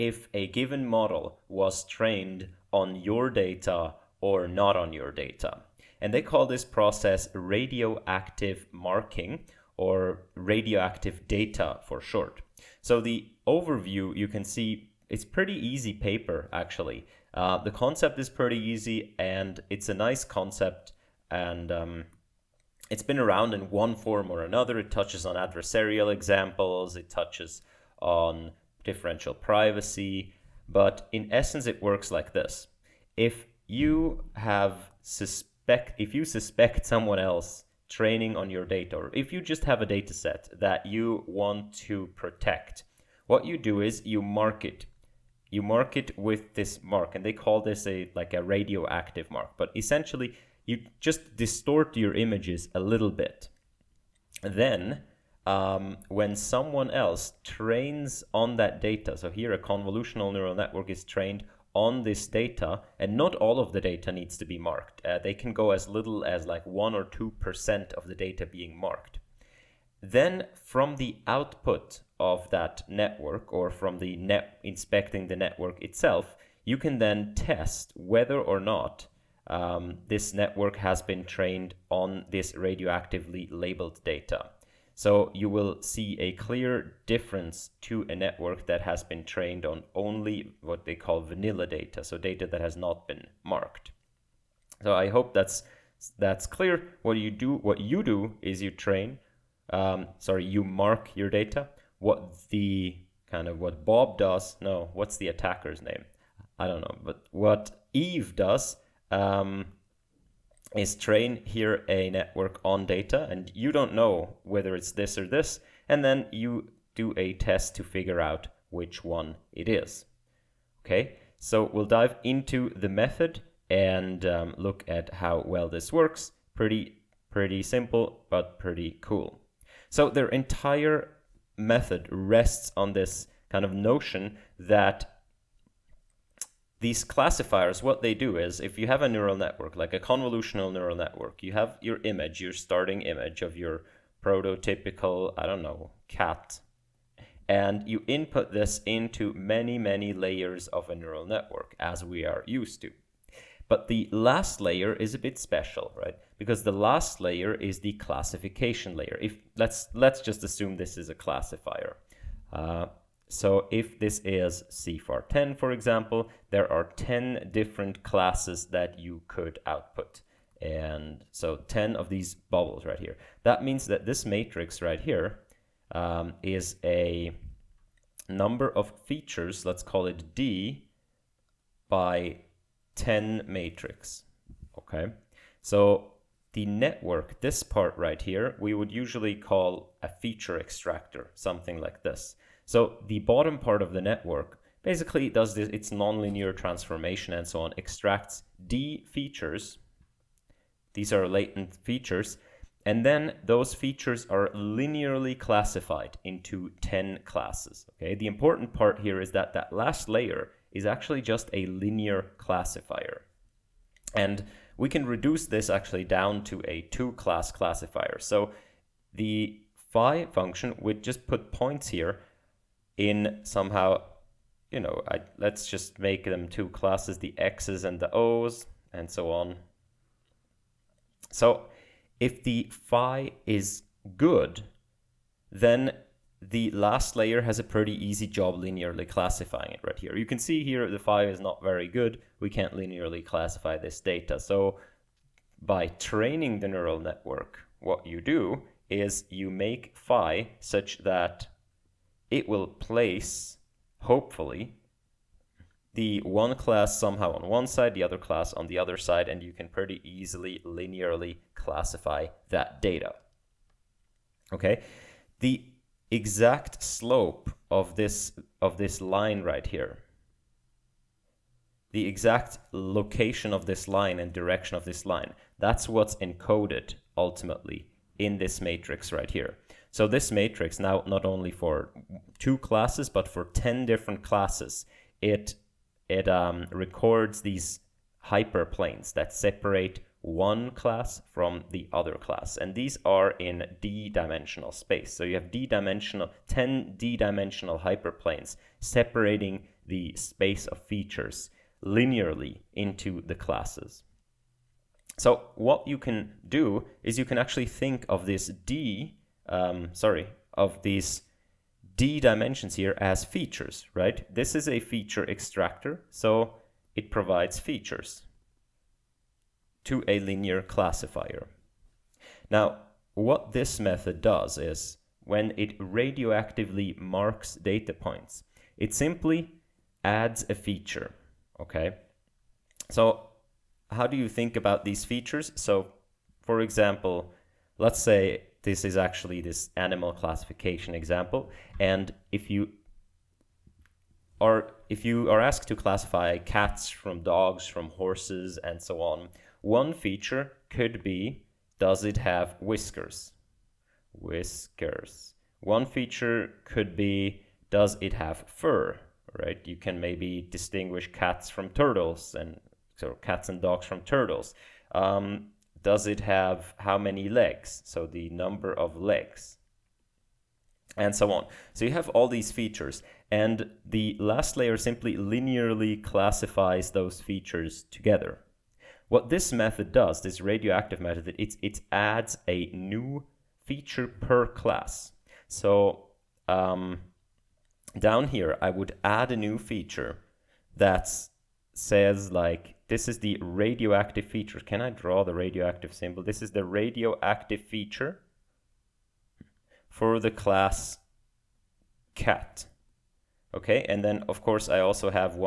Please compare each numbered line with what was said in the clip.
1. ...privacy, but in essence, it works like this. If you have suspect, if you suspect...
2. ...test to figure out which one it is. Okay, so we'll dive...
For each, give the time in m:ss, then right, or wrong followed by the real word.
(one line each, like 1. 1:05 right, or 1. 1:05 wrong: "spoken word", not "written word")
1. 0:29 right
2. 1:57 right.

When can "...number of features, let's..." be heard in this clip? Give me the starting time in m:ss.
2:58.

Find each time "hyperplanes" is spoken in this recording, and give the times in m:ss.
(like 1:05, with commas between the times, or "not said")
4:48, 4:57.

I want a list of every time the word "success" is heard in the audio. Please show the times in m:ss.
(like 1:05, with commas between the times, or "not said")
not said.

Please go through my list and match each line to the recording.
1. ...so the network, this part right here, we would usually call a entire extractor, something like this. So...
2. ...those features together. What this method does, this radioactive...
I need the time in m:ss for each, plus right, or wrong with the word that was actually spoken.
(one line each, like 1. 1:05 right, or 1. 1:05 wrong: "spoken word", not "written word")
1. 3:05 wrong: "feature", not "entire"
2. 6:16 right.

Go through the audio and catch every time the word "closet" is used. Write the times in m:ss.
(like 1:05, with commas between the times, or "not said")
not said.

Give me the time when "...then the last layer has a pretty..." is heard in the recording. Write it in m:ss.
3:55.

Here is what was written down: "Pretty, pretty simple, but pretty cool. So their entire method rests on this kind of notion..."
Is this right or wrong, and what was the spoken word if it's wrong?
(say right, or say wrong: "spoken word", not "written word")
right.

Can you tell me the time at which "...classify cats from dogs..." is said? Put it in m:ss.
5:45.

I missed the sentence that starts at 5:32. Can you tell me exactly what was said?
So how do you think about these features?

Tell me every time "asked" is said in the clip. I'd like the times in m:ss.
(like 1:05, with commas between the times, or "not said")
5:45.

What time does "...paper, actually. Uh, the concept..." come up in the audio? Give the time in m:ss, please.
0:15.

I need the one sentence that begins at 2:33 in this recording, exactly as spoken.
But the last layer is a bit special, right?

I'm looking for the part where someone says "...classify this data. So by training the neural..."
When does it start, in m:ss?
4:03.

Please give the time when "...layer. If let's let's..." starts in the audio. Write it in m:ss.
2:38.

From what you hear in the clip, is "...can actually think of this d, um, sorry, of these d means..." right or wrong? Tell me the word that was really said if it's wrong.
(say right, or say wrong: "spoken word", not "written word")
wrong: "dimensions", not "means".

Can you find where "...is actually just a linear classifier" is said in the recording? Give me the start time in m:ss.
3:30.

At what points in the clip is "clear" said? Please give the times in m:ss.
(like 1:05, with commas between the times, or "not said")
1:26, 1:36.